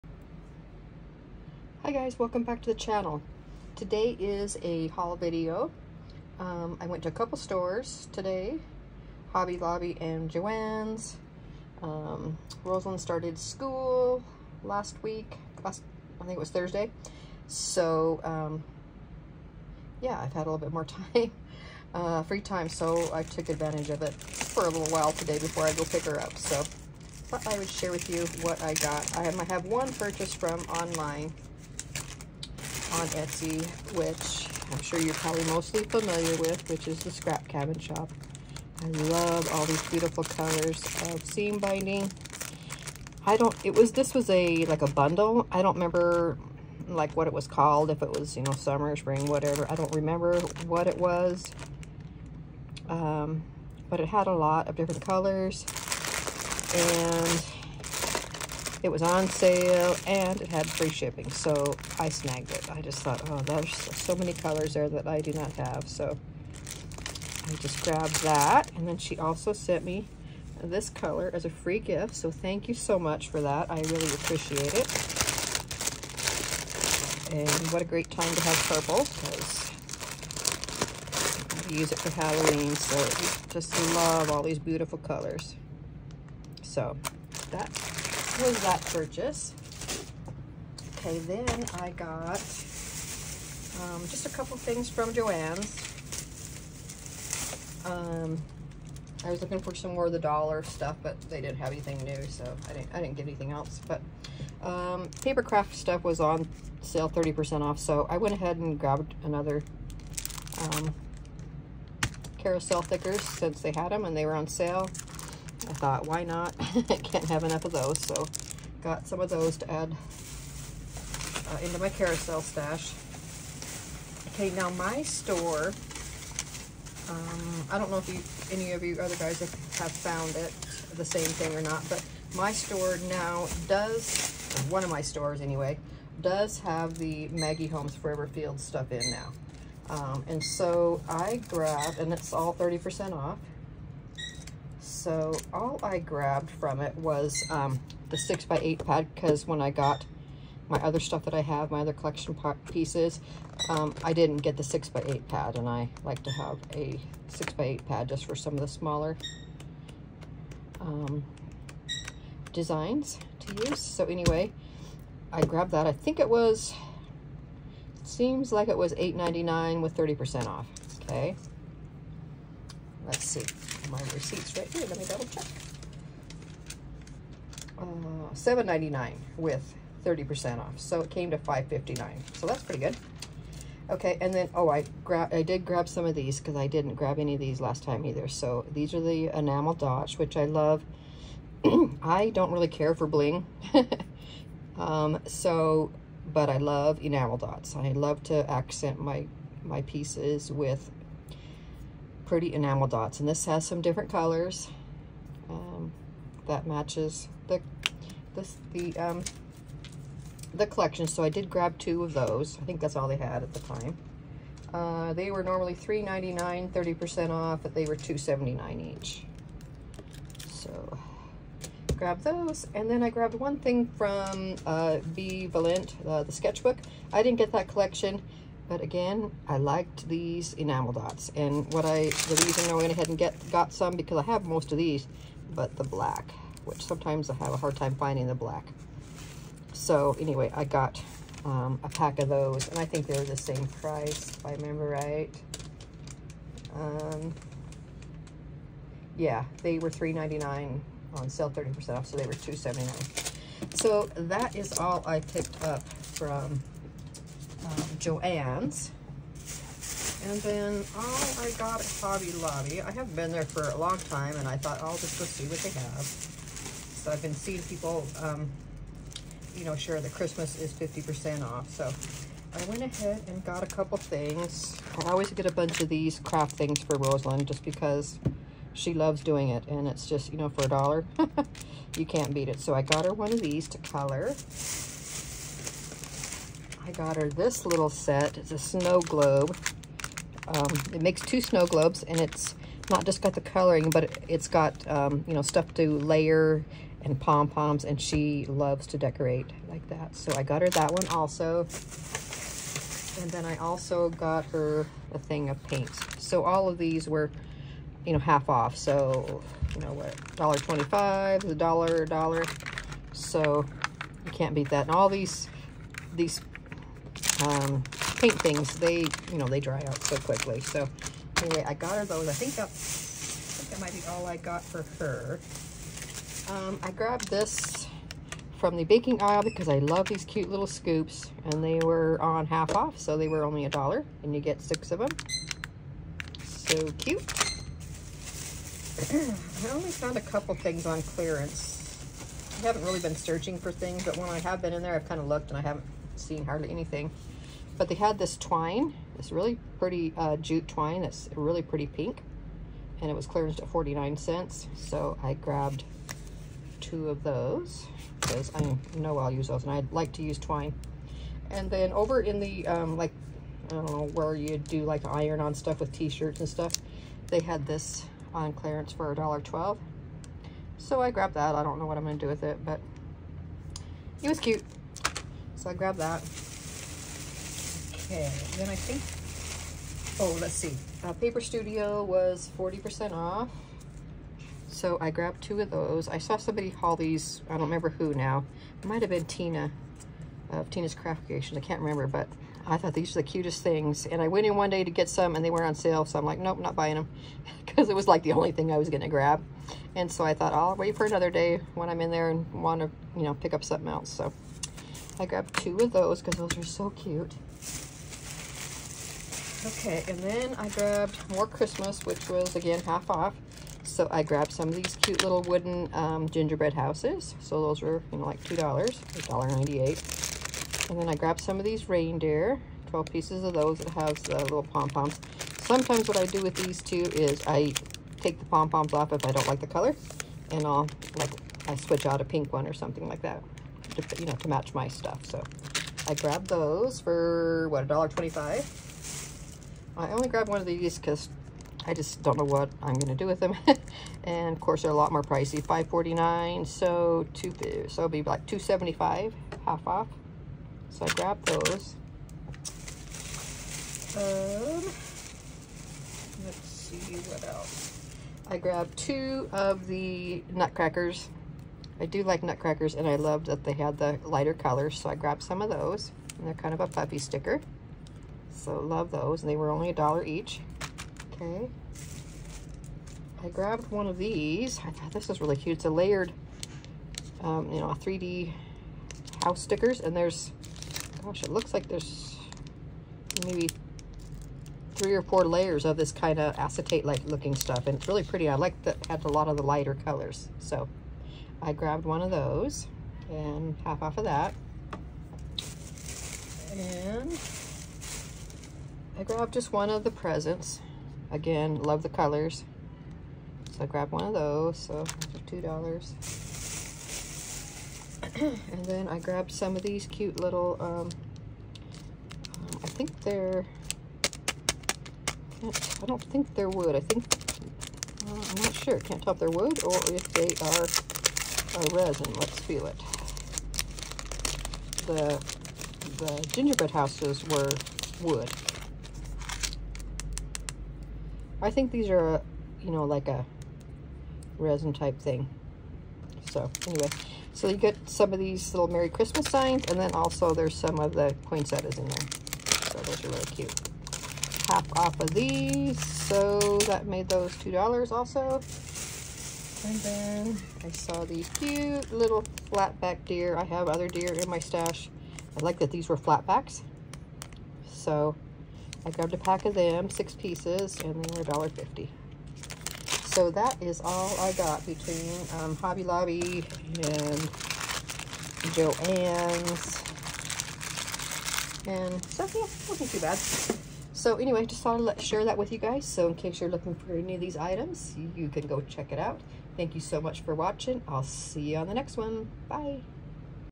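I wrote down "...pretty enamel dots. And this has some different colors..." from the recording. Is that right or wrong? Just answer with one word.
right.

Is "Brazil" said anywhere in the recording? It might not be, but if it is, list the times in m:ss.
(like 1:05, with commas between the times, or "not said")
not said.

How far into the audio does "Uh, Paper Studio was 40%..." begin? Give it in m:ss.
6:21.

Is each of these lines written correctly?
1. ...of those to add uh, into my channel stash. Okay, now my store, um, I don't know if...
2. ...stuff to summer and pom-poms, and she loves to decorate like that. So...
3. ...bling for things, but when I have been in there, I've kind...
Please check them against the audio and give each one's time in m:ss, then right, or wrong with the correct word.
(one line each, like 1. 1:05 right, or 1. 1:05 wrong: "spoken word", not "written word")
1. 1:59 wrong: "carousel", not "channel"
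2. 4:55 wrong: "layer", not "summer"
3. 5:43 wrong: "searching", not "bling".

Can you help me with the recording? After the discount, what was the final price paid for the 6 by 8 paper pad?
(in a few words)
$5.59.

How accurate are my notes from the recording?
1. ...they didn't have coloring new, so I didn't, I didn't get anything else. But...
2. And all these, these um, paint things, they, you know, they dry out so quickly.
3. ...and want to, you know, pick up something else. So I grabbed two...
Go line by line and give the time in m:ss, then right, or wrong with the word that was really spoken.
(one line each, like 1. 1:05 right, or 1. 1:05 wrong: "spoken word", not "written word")
1. 1:41 wrong: "anything", not "coloring"
2. 5:14 right
3. 6:42 right.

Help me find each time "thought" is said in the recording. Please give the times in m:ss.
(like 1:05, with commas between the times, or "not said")
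0:27, 1:02, 1:55, 4:24, 6:32, 6:40, 7:54, 9:34.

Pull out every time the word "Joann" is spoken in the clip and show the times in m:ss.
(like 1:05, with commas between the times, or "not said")
0:10, 1:35, 4:17, 9:28.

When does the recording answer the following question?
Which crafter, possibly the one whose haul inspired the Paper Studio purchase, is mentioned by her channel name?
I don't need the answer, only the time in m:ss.
6:30.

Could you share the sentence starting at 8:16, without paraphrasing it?
And I grabbed just one of the presents.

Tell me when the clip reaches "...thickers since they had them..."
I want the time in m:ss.
1:52.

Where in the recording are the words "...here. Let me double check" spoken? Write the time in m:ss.
2:54.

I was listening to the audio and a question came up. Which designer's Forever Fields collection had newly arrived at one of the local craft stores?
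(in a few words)
Maggie Holmes.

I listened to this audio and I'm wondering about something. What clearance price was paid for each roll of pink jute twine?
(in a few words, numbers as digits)
49 cents.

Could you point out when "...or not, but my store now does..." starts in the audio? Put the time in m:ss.
2:11.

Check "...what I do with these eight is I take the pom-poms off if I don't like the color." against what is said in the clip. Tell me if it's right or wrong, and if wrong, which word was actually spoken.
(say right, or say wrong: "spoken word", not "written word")
wrong: "two", not "eight".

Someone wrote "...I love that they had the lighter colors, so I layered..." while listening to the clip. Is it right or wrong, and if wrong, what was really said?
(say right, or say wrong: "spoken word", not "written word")
wrong: "grabbed", not "layered".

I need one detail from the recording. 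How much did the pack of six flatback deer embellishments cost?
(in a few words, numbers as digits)
$1.50.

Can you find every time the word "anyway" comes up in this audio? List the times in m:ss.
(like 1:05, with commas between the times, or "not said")
2:15, 2:44, 4:00, 5:21, 8:56, 9:34.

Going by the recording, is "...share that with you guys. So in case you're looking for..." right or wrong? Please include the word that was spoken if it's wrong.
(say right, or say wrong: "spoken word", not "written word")
right.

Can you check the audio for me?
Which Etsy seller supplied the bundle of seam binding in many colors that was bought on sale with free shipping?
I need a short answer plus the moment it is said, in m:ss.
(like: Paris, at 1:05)
Scrap Cabin Shop, at 0:37.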